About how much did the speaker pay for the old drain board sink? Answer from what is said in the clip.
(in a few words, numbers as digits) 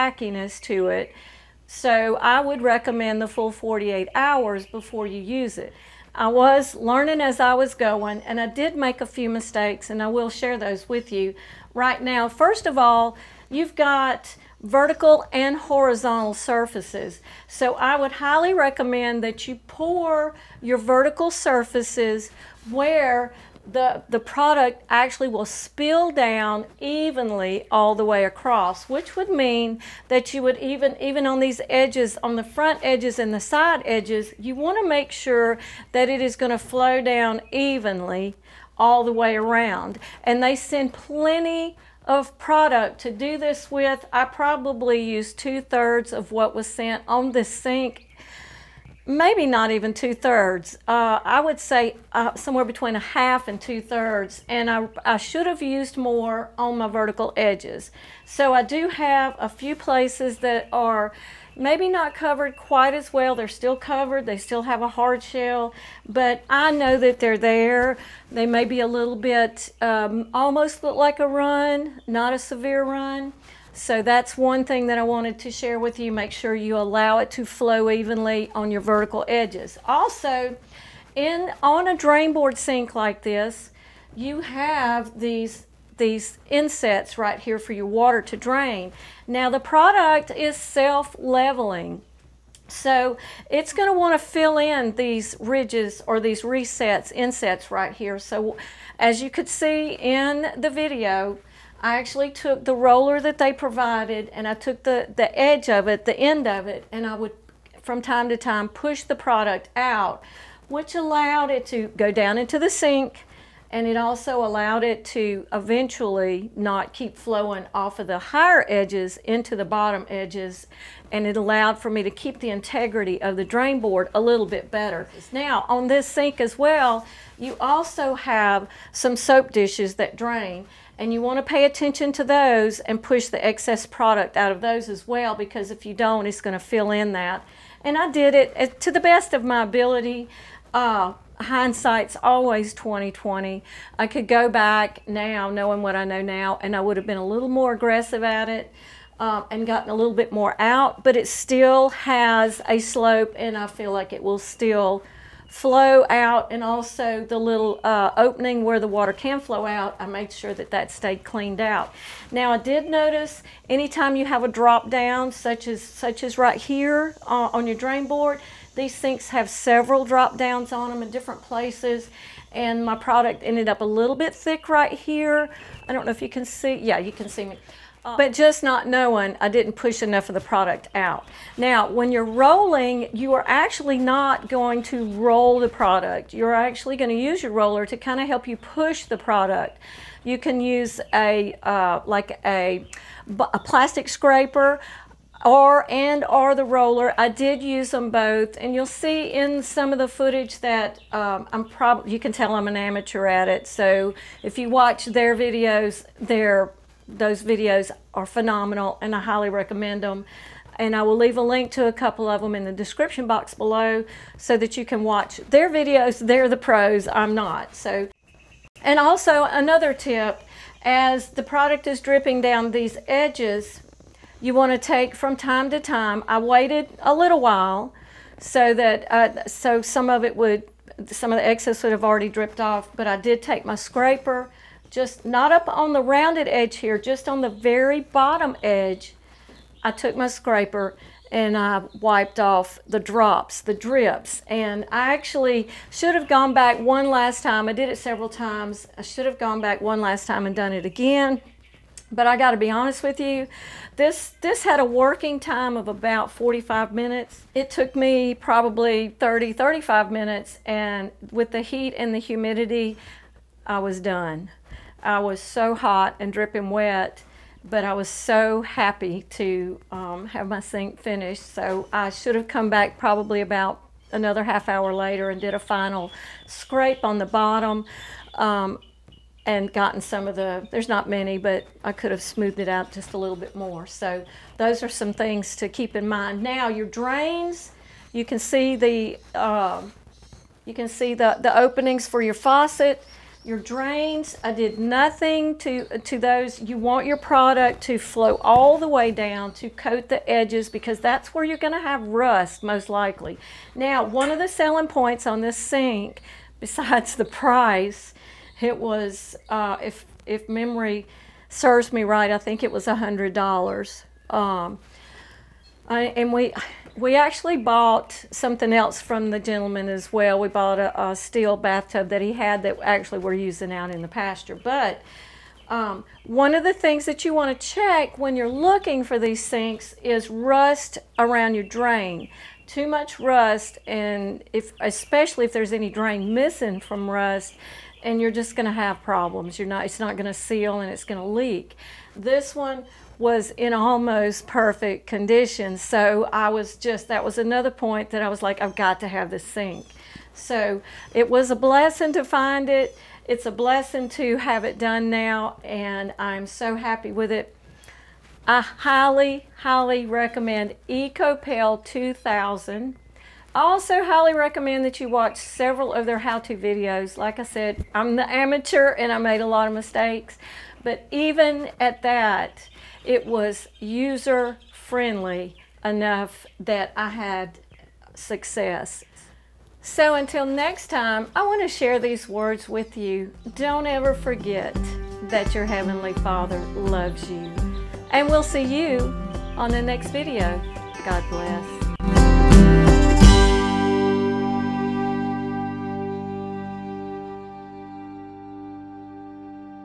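$100.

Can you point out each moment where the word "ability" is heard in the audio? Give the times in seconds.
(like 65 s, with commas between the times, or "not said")
139 s.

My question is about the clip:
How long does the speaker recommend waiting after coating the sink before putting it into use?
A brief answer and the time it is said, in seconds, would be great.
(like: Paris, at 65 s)
48 hours, at 3 s.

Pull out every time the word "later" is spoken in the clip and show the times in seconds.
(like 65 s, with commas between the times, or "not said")
274 s.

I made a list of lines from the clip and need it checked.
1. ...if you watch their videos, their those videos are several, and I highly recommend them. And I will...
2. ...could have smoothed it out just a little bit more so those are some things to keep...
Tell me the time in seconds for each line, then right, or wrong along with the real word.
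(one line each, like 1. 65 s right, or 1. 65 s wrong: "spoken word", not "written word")
1. 204 s wrong: "phenomenal", not "several"
2. 281 s right.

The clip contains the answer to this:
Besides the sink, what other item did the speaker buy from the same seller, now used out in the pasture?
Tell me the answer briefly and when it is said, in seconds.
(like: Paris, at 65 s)
steel bathtub, at 321 s.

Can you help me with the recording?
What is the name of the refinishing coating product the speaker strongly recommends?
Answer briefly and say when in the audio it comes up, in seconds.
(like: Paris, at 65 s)
Ekopel 2000, at 360 s.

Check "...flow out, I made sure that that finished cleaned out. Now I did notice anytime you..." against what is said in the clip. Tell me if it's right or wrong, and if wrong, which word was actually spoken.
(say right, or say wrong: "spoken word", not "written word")
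wrong: "stayed", not "finished".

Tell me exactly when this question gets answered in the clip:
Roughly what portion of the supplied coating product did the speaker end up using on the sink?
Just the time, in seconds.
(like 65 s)
52 s.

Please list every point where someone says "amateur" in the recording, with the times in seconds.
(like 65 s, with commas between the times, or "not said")
202 s, 368 s.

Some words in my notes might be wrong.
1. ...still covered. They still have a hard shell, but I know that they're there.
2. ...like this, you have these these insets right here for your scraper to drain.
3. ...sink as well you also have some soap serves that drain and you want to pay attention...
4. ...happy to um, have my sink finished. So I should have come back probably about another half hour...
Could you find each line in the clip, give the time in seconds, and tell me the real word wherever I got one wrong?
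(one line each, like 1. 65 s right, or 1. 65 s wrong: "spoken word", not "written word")
1. 63 s right
2. 82 s wrong: "water", not "scraper"
3. 126 s wrong: "dishes", not "serves"
4. 268 s right.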